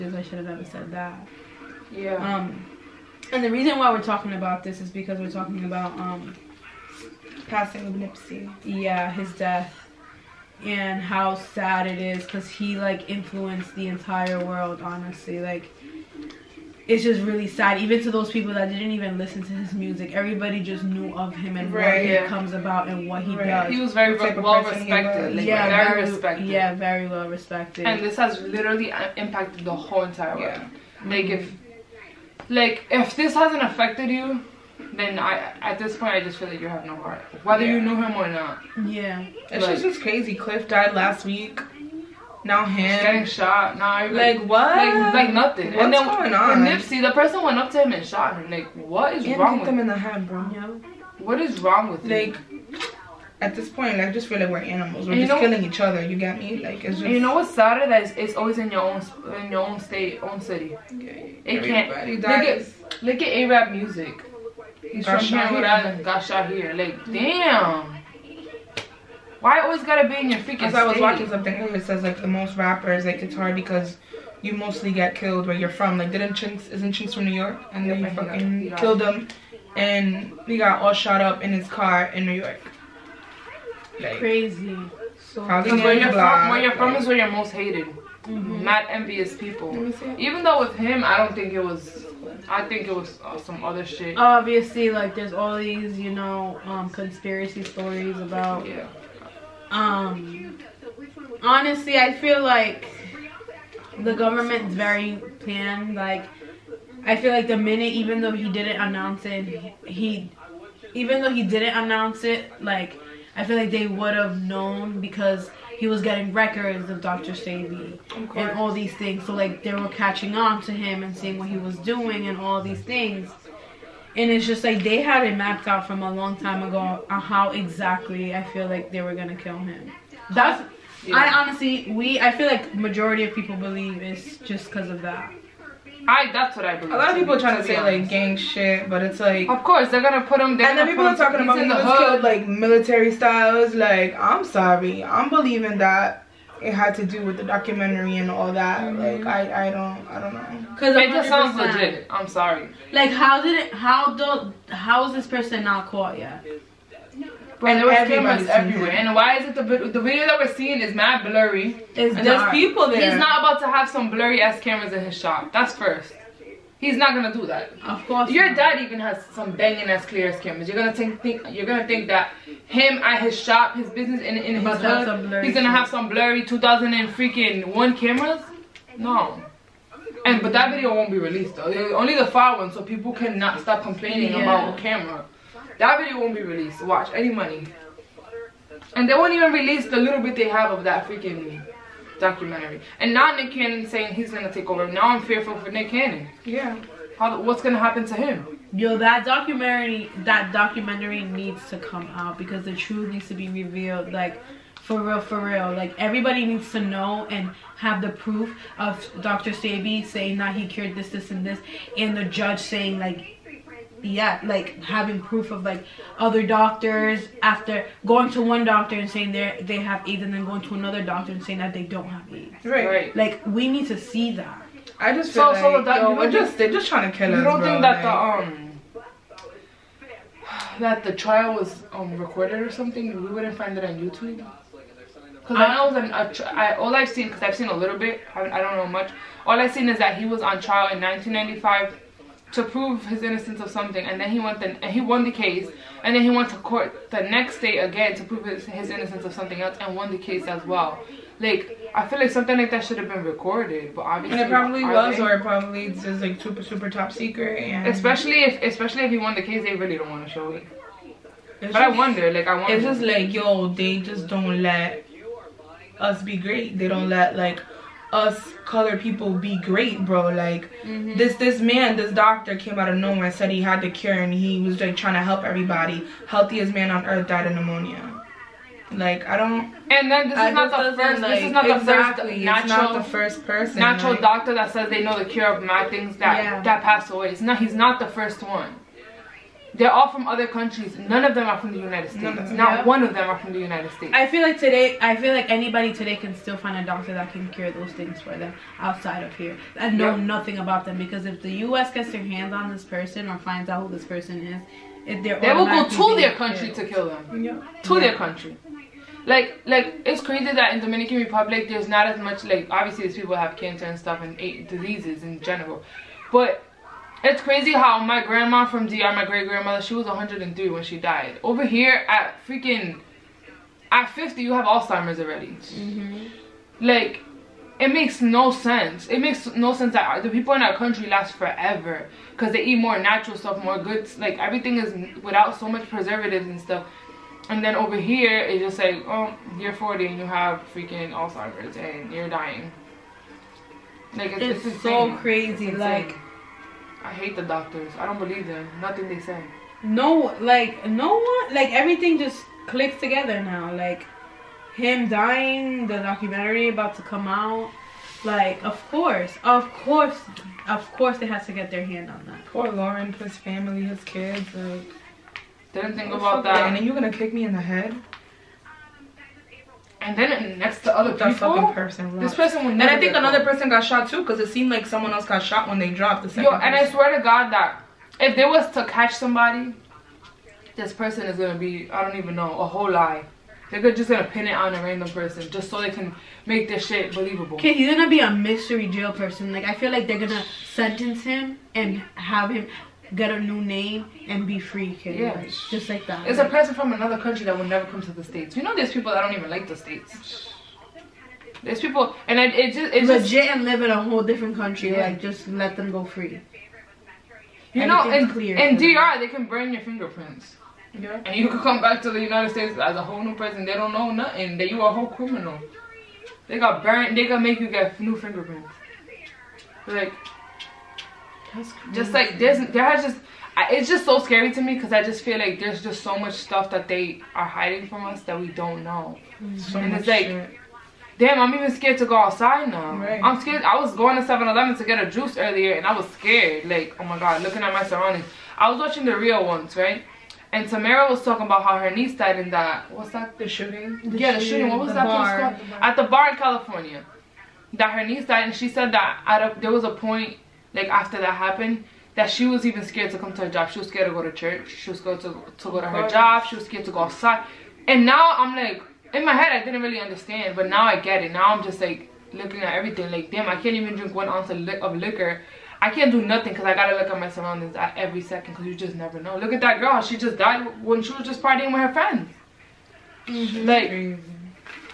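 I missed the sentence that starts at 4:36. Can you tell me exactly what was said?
Healthiest man on earth died of pneumonia.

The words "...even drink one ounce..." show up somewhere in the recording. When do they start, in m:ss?
7:43.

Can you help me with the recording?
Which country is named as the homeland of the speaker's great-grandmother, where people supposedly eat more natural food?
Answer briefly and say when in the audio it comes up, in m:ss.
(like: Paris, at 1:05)
Dominican Republic, at 5:10.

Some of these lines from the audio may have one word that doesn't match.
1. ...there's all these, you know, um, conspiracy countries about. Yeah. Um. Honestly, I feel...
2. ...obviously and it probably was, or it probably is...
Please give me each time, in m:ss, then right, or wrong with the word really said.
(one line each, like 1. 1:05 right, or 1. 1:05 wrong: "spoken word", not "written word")
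1. 1:35 wrong: "stories", not "countries"
2. 4:14 right.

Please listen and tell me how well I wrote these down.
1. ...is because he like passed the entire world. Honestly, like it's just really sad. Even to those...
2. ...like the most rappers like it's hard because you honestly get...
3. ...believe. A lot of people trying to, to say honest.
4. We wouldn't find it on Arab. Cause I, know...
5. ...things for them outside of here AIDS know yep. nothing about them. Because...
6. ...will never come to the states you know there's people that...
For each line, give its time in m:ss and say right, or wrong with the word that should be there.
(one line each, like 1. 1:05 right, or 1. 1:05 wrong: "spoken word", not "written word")
1. 0:11 wrong: "influenced", not "passed"
2. 1:12 wrong: "mostly", not "honestly"
3. 2:16 right
4. 3:53 wrong: "YouTube", not "Arab"
5. 4:57 wrong: "And", not "AIDS"
6. 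6:37 right.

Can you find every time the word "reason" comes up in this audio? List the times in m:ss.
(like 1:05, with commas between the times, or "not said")
0:03.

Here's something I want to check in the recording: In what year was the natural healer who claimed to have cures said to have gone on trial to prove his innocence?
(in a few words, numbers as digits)
1995.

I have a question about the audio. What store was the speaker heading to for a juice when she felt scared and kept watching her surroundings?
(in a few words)
7-Eleven.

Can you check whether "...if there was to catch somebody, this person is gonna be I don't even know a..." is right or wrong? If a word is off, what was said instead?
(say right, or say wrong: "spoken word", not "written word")
right.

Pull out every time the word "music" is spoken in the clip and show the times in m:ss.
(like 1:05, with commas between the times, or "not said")
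0:19, 1:03.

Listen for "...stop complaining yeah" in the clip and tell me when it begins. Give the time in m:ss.
3:03.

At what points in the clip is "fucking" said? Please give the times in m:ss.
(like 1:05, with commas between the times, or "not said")
1:18, 6:11.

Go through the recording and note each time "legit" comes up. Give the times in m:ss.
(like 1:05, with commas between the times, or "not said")
2:31, 6:43.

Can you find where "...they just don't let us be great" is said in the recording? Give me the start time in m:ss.
4:23.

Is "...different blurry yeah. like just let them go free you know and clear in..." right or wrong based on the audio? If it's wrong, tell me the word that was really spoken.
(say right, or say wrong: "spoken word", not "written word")
wrong: "country", not "blurry".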